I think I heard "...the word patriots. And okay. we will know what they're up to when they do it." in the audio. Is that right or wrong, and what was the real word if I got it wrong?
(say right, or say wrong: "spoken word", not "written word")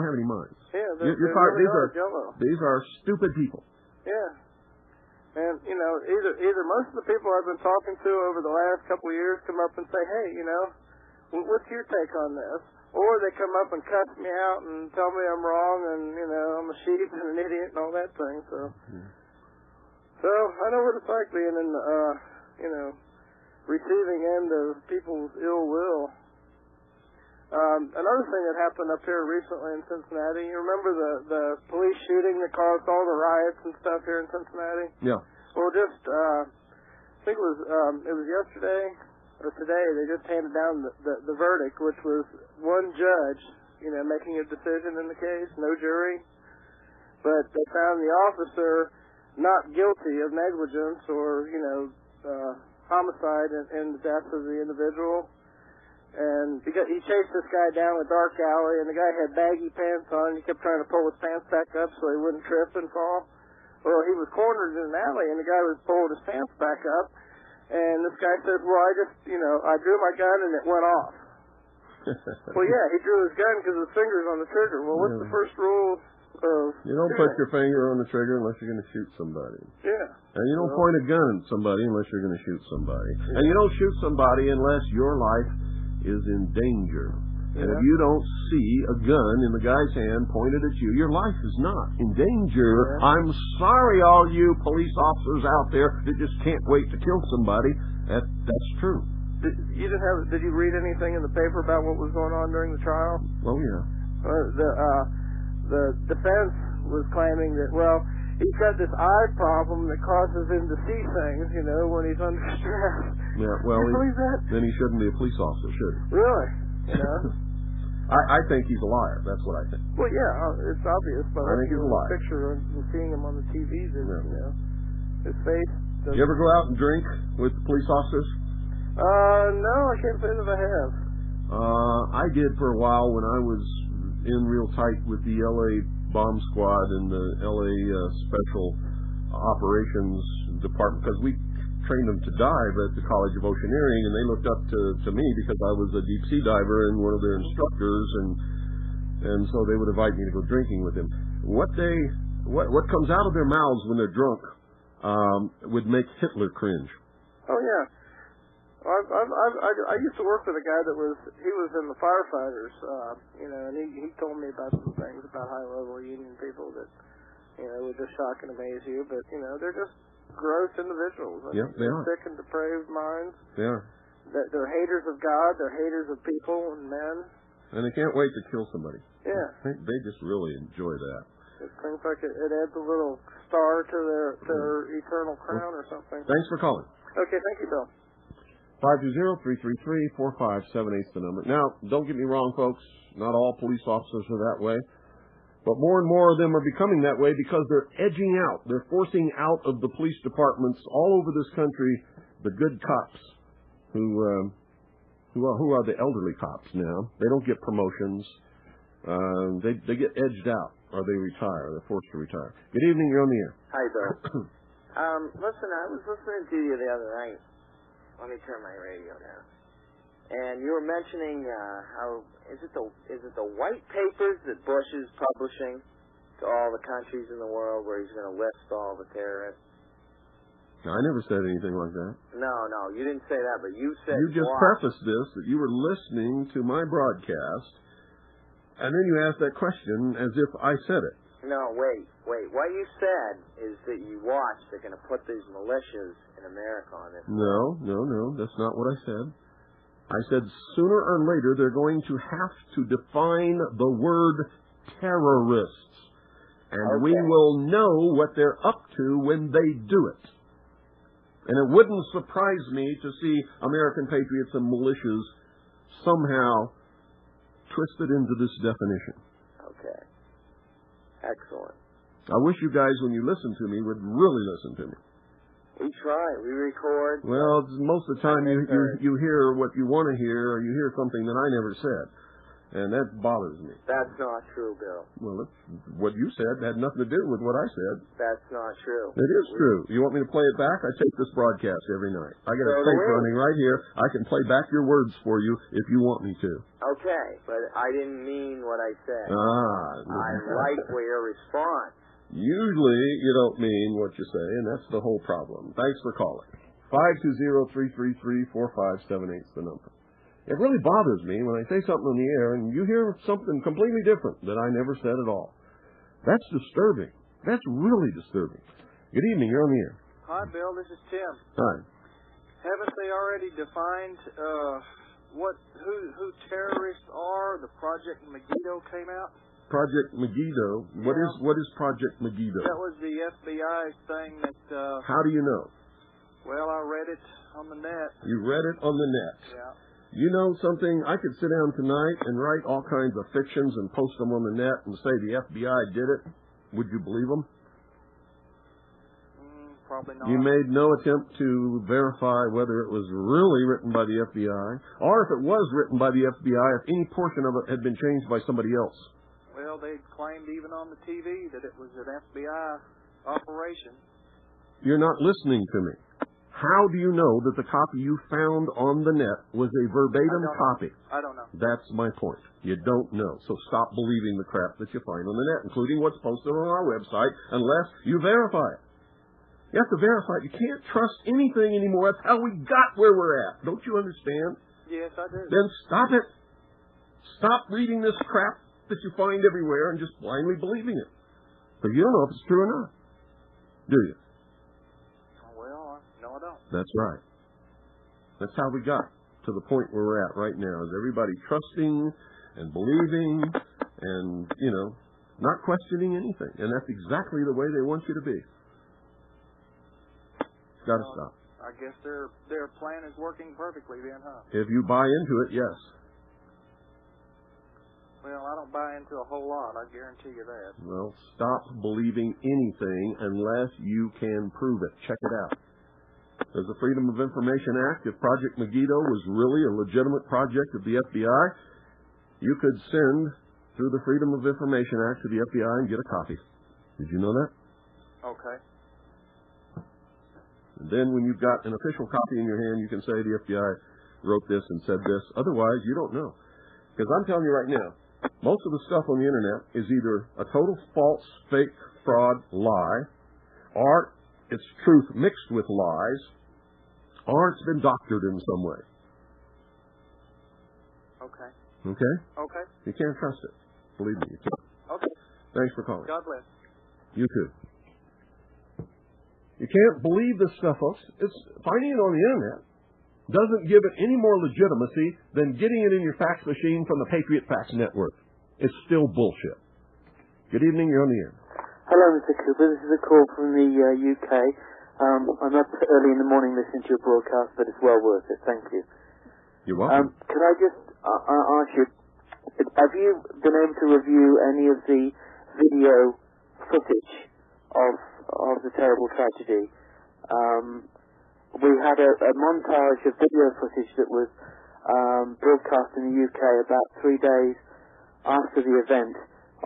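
wrong: "terrorists", not "patriots".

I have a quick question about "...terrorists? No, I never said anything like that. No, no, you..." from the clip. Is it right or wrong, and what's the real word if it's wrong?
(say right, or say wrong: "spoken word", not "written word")
right.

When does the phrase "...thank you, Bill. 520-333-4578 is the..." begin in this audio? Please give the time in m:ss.
3:07.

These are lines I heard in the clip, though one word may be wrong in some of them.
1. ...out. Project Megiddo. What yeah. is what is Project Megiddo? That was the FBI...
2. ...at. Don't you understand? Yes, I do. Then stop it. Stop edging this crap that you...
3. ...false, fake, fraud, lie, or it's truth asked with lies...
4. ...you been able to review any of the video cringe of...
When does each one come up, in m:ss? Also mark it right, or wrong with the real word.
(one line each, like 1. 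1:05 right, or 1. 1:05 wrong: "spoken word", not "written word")
1. 5:29 right
2. 6:23 wrong: "reading", not "edging"
3. 7:30 wrong: "mixed", not "asked"
4. 8:12 wrong: "footage", not "cringe".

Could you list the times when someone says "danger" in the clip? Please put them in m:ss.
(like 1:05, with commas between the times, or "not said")
1:26, 1:32.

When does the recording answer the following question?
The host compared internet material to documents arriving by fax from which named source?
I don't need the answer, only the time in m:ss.
7:57.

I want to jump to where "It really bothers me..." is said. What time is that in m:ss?
5:10.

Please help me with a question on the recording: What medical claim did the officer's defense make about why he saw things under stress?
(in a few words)
Eye problem.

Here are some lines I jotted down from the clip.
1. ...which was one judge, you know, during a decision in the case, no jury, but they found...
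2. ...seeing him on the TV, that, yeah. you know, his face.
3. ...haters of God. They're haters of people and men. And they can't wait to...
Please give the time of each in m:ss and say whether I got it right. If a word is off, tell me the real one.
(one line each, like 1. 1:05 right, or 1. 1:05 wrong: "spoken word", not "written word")
1. 0:41 wrong: "making", not "during"
2. 2:02 right
3. 2:54 right.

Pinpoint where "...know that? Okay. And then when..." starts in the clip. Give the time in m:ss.
7:17.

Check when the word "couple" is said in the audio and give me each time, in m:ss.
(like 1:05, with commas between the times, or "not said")
0:08.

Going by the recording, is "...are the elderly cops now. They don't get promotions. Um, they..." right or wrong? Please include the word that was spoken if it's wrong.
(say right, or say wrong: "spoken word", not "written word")
right.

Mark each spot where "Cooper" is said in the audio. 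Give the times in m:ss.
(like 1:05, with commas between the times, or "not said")
8:02.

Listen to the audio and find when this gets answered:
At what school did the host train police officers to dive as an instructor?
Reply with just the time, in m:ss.
2:23.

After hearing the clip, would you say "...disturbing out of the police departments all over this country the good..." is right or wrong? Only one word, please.
wrong.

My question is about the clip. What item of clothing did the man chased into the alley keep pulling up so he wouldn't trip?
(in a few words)
Baggy pants.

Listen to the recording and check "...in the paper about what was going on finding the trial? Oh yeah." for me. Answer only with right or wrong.
wrong.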